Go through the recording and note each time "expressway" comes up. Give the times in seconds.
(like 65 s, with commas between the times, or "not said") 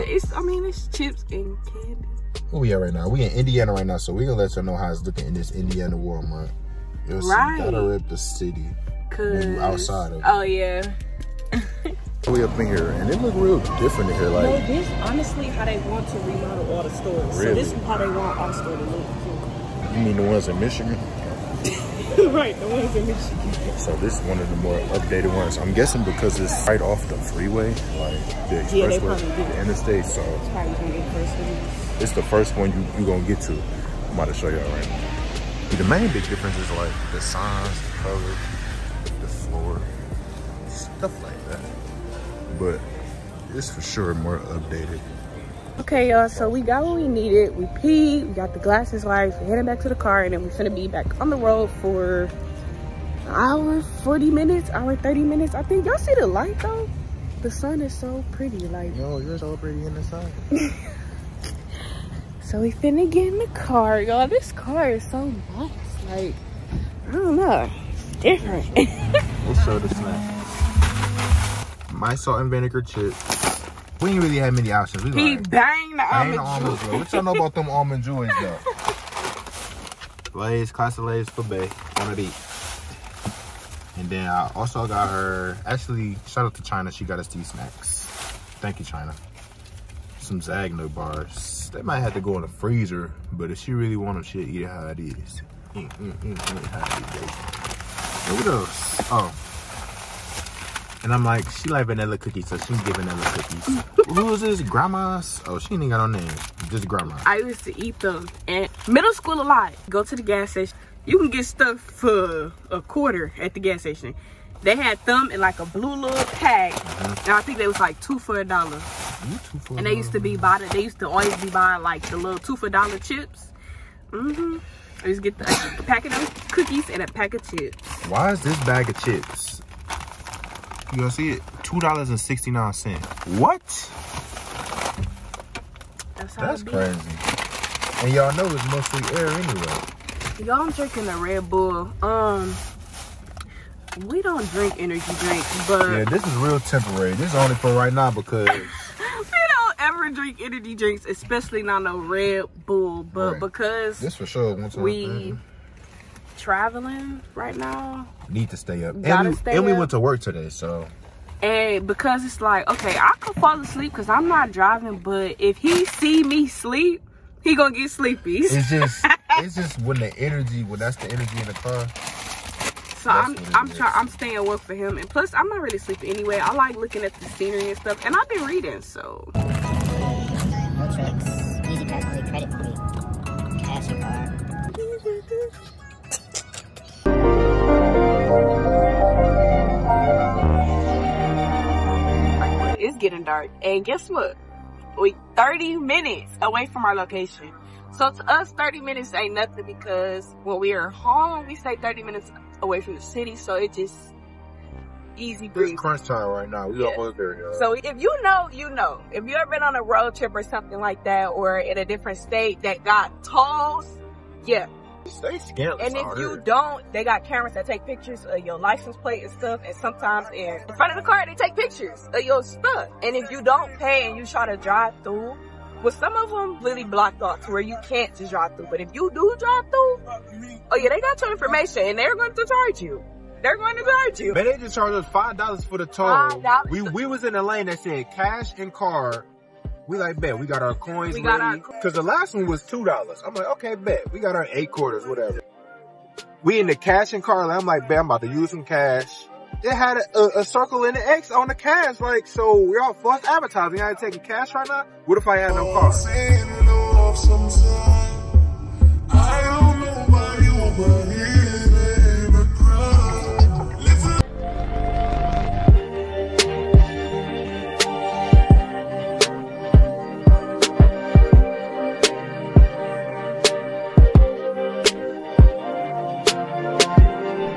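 28 s.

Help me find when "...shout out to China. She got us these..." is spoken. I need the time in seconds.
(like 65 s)
86 s.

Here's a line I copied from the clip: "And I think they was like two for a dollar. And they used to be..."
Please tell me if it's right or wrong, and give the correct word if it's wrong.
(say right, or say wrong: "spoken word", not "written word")
right.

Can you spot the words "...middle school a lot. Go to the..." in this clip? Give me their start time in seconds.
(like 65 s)
108 s.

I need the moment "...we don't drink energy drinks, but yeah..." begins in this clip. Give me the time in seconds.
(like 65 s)
144 s.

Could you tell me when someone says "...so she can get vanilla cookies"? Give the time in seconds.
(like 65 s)
102 s.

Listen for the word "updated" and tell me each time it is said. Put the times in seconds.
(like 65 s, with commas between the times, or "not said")
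24 s, 44 s.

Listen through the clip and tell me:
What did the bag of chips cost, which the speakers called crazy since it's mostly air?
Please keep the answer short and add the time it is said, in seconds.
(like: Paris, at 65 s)
$2.69, at 131 s.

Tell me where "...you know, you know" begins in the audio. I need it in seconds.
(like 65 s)
208 s.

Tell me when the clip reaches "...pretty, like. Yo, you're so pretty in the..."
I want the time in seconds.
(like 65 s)
58 s.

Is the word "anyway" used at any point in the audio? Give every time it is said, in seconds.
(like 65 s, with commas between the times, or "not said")
139 s, 176 s.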